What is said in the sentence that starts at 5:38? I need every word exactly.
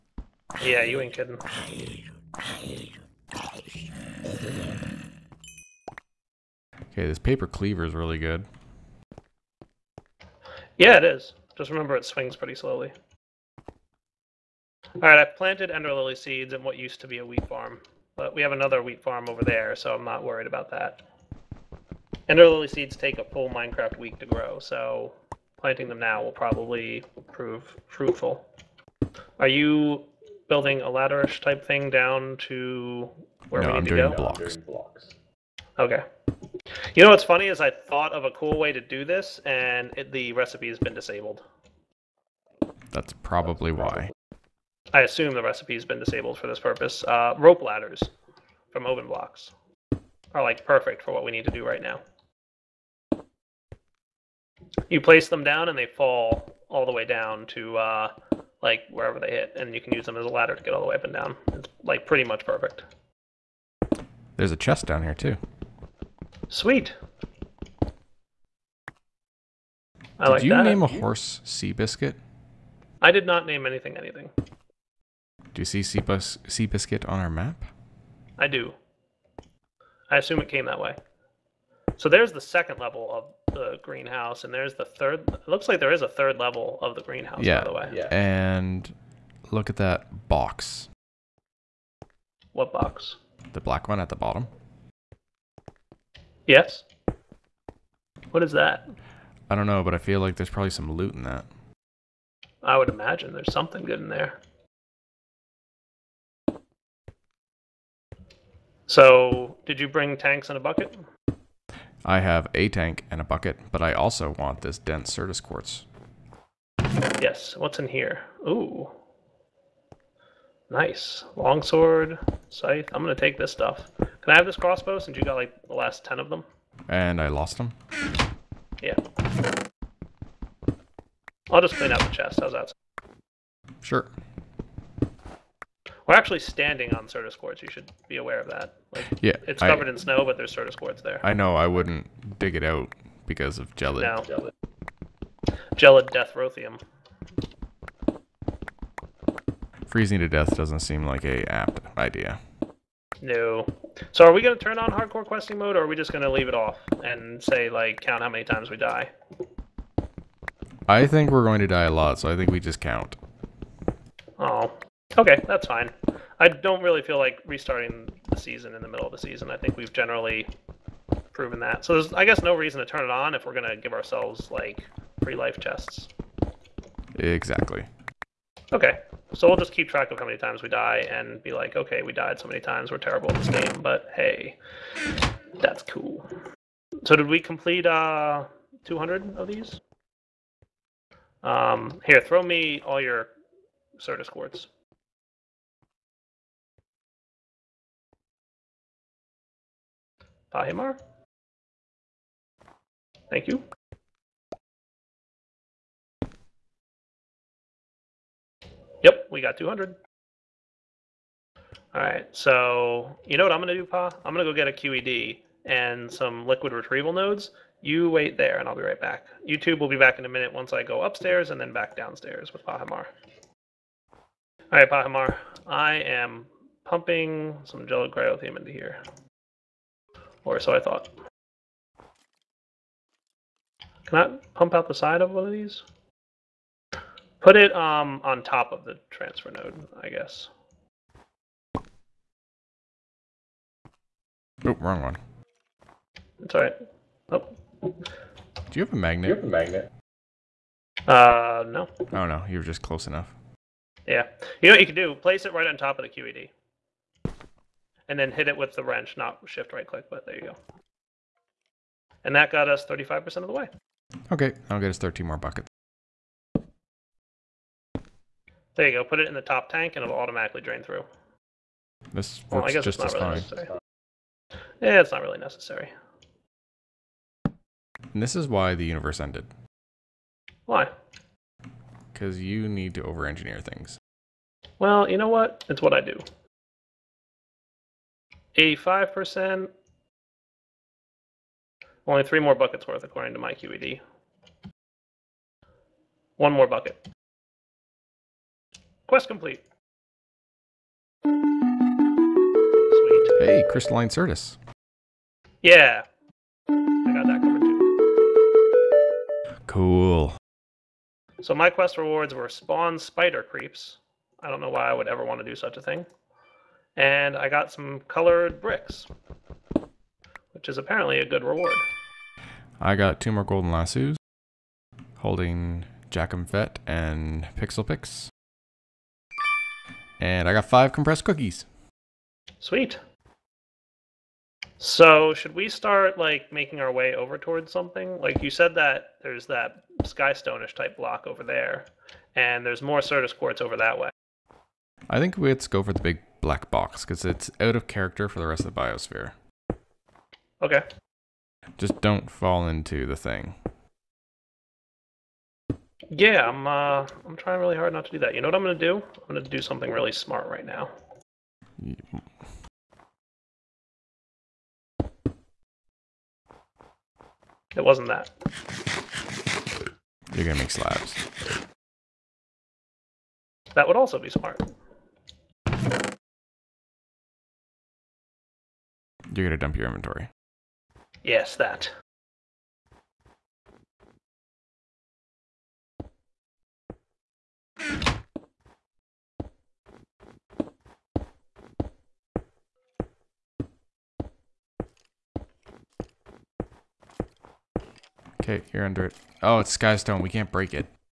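Like you said that there's that skystone-ish type block over there, and there's more Certus quartz over that way.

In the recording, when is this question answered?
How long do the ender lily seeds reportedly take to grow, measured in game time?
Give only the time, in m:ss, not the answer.
0:23.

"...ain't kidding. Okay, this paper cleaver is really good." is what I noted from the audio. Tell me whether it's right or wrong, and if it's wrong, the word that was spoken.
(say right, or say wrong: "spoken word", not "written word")
right.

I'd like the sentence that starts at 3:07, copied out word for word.
So did we complete uh, 200 of these?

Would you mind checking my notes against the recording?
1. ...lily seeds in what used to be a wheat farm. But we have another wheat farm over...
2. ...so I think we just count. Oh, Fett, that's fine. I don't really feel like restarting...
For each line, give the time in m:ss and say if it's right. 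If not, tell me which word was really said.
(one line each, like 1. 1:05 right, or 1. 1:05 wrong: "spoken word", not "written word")
1. 0:15 right
2. 2:42 wrong: "Okay", not "Fett".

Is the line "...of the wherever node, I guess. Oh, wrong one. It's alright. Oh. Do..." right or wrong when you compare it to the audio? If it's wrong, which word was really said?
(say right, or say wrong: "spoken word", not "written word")
wrong: "transfer", not "wherever".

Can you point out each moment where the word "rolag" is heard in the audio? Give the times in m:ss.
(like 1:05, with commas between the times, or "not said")
not said.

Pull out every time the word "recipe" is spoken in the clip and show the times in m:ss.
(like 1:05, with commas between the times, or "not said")
0:40, 0:45.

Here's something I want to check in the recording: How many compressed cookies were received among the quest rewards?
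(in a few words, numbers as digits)
5.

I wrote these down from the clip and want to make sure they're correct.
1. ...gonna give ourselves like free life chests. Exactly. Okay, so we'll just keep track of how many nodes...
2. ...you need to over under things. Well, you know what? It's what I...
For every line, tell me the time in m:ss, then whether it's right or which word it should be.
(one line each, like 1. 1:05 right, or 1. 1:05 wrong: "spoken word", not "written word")
1. 2:53 wrong: "times", not "nodes"
2. 4:42 wrong: "engineer", not "under".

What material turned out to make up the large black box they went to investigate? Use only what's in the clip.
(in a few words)
Skystone.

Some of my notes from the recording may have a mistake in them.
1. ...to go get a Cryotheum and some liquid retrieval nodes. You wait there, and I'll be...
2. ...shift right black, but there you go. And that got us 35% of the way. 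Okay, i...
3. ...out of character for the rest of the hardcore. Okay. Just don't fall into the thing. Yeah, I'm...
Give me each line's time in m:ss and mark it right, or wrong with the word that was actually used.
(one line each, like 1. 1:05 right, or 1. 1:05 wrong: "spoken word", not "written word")
1. 3:34 wrong: "QED", not "Cryotheum"
2. 4:19 wrong: "click", not "black"
3. 5:47 wrong: "biosphere", not "hardcore".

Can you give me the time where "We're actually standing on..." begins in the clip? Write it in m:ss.
2:16.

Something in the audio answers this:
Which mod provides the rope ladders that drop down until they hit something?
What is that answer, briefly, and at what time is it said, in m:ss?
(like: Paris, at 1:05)
Open Blocks, at 0:48.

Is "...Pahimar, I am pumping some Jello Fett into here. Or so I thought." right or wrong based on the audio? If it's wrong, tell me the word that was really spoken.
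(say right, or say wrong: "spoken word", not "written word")
wrong: "Cryotheum", not "Fett".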